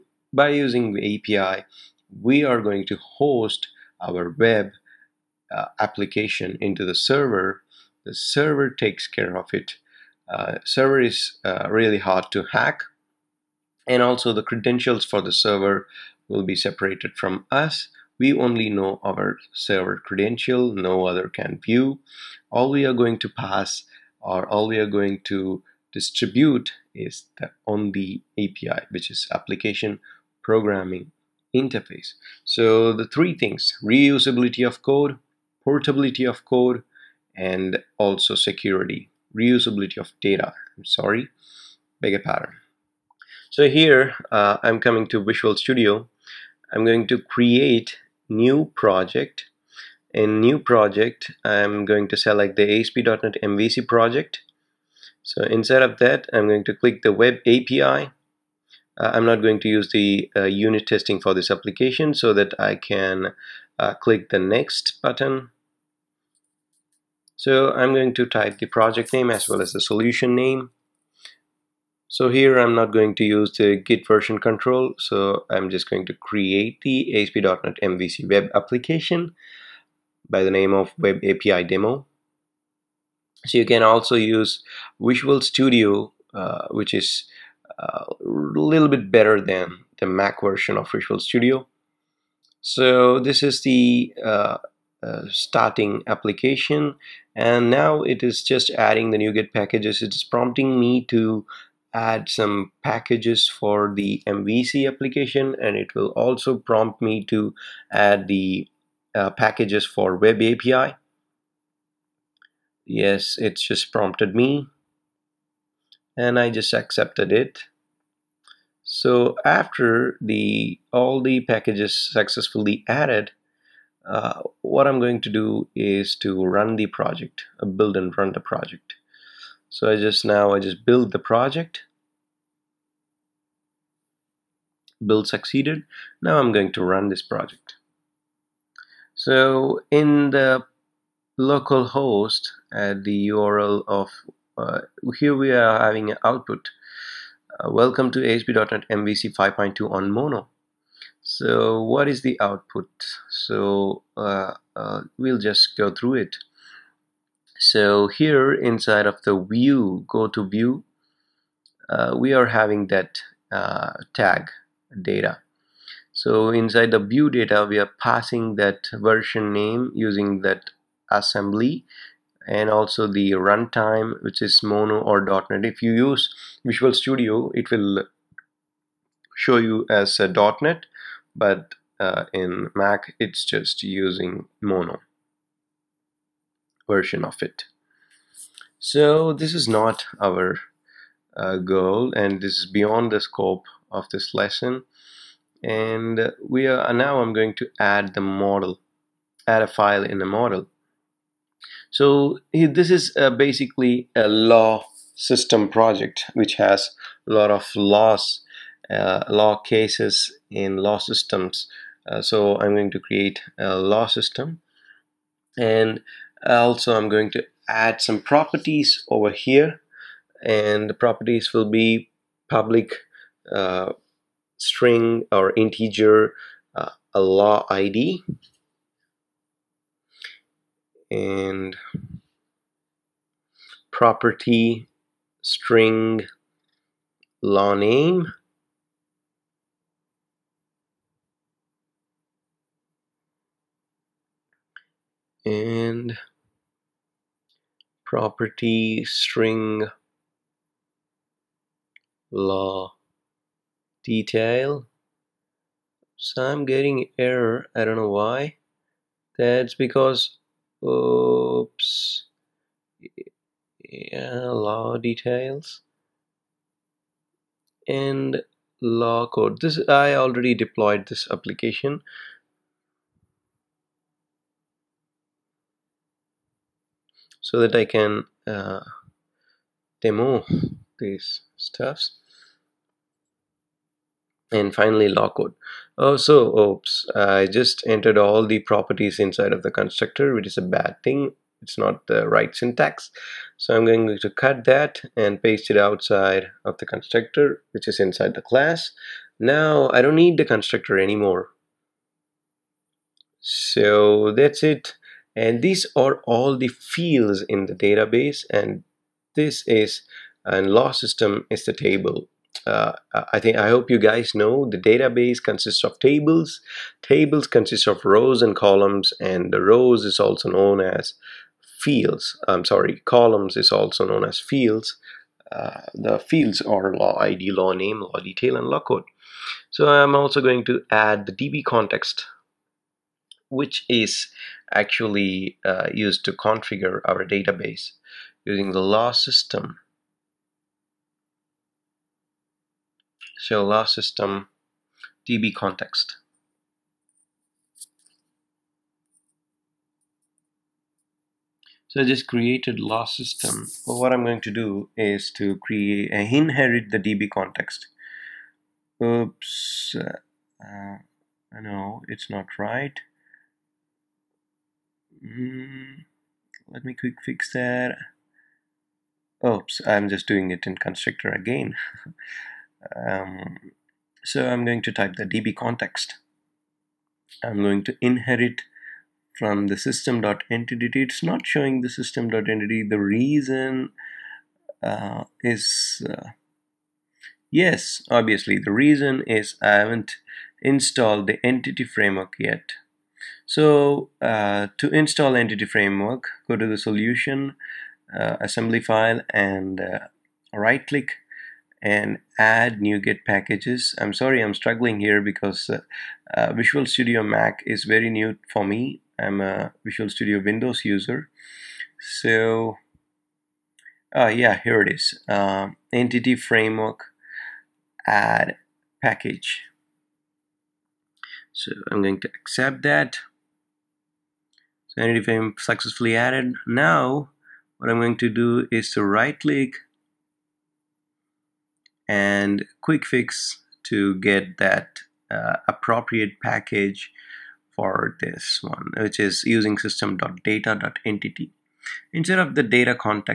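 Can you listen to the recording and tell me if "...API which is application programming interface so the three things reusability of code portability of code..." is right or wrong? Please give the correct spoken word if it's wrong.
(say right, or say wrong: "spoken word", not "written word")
right.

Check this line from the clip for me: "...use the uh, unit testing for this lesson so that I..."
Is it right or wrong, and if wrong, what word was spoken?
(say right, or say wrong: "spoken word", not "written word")
wrong: "application", not "lesson".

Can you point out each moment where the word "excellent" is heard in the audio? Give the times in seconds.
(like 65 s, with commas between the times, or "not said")
not said.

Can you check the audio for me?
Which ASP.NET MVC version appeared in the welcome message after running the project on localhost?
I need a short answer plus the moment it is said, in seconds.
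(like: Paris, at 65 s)
5.2, at 149 s.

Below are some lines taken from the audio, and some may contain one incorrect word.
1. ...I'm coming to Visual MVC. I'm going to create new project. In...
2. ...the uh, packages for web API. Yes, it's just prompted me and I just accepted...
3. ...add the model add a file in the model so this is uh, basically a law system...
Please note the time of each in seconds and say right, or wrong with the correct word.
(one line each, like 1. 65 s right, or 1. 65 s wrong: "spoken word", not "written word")
1. 44 s wrong: "Studio", not "MVC"
2. 108 s right
3. 197 s right.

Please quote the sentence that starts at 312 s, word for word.
Uh, I think I hope you guys know the database consists of tables.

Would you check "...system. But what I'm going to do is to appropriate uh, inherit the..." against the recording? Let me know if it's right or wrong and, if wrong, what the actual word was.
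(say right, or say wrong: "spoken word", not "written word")
wrong: "create", not "appropriate".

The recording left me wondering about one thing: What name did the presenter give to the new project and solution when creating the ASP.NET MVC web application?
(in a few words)
Web API Demo.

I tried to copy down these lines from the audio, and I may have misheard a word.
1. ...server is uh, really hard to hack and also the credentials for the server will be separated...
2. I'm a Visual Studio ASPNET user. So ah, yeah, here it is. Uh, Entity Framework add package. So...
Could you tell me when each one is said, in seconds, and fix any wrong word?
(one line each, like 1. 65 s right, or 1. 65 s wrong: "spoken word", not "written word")
1. 10 s right
2. 409 s wrong: "Windows", not "ASPNET".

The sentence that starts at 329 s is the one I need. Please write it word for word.
So I'm also going to add the DB context which is actually uh, used to configure our database using the law system.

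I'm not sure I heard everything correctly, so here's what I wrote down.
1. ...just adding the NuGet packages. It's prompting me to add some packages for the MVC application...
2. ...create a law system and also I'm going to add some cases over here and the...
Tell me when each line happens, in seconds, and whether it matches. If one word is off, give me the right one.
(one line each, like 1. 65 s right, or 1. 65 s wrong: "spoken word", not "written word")
1. 98 s right
2. 212 s wrong: "properties", not "cases".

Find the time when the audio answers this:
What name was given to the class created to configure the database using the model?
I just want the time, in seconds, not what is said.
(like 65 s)
343 s.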